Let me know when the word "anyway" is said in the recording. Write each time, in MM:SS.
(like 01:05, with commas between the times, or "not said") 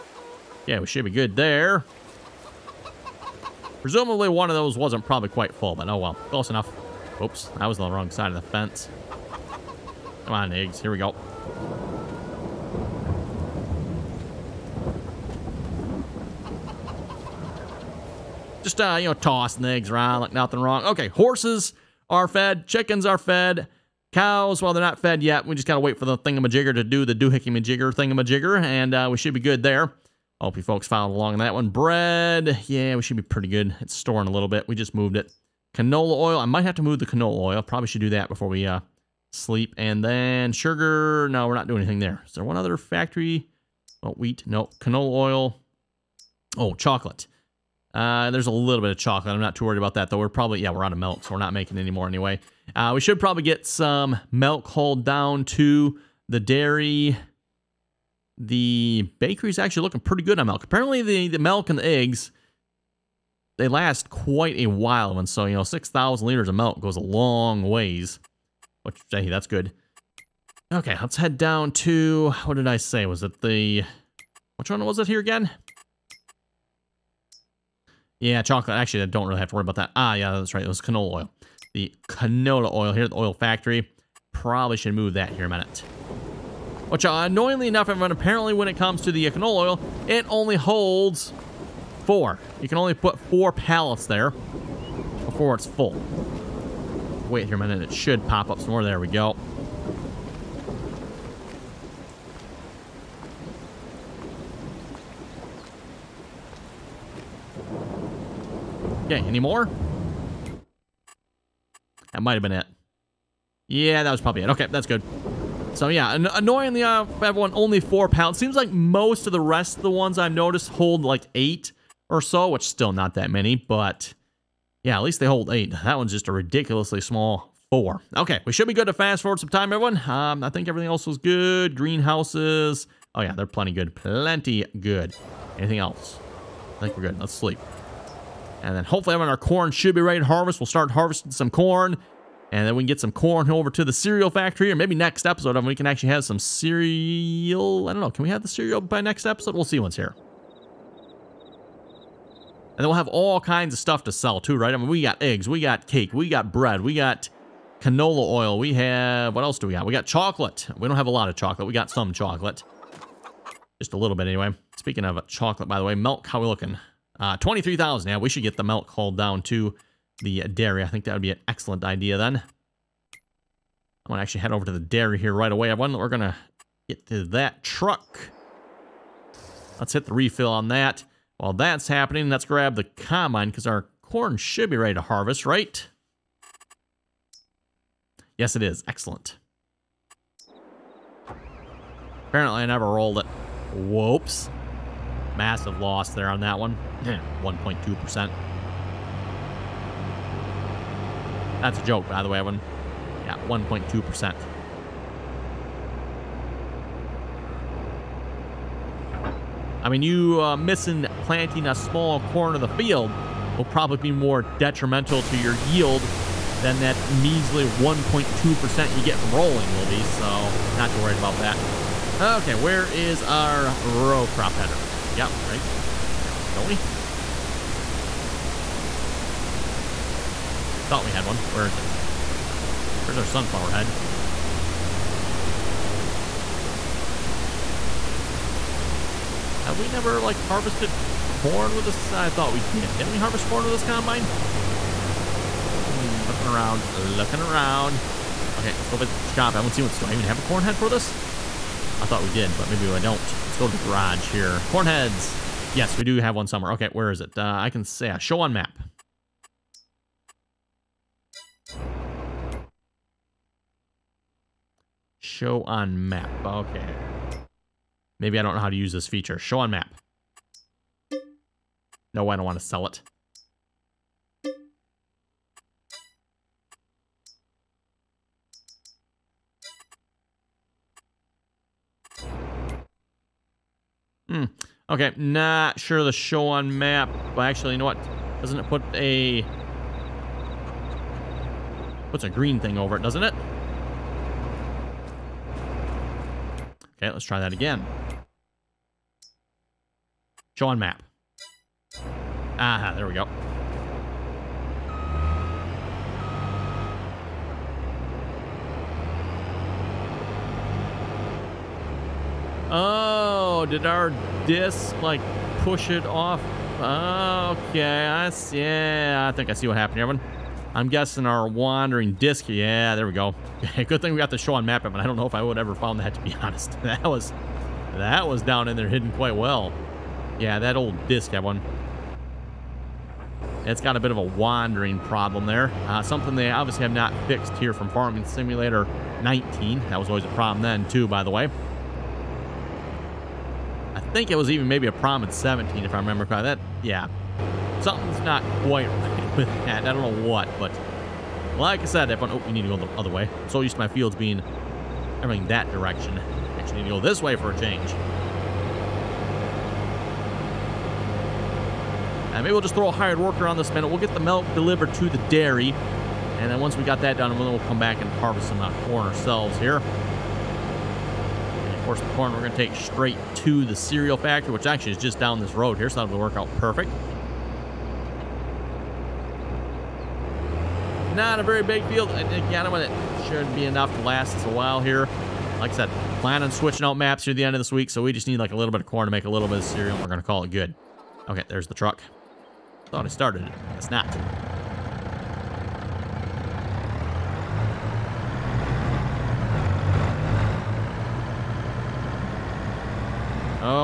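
00:52, 02:44.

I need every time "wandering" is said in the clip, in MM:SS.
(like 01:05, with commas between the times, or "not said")
05:21, 05:34.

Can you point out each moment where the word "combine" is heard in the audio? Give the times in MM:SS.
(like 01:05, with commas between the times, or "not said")
03:02, 04:03.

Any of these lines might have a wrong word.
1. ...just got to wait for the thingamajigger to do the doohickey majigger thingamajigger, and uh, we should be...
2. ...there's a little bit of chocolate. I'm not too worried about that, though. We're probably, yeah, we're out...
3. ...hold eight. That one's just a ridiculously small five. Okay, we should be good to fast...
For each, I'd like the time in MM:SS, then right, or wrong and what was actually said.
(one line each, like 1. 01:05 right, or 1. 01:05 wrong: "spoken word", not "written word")
1. 00:25 right
2. 00:48 right
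3. 02:05 wrong: "four", not "five".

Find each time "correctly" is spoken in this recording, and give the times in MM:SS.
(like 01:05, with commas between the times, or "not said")
05:46.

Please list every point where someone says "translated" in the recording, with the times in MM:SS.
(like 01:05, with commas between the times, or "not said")
not said.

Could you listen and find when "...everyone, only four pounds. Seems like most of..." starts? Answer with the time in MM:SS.
01:57.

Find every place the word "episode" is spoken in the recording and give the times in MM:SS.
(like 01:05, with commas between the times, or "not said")
02:25, 02:29.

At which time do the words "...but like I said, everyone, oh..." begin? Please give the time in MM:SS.
05:50.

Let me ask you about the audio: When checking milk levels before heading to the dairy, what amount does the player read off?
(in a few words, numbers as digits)
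23,000.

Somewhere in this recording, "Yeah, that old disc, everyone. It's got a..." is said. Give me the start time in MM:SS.
05:30.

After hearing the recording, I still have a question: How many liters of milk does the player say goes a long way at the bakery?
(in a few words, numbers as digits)
6,000.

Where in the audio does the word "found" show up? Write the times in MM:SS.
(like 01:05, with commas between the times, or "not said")
05:25.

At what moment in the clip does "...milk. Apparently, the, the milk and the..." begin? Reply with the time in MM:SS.
01:00.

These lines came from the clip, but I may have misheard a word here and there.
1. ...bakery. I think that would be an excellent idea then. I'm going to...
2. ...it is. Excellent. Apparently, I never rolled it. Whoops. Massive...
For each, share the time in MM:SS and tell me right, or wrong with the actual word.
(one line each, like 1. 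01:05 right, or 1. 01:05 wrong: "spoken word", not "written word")
1. 02:50 wrong: "dairy", not "bakery"
2. 03:08 right.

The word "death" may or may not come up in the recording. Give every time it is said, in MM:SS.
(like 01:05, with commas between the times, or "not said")
not said.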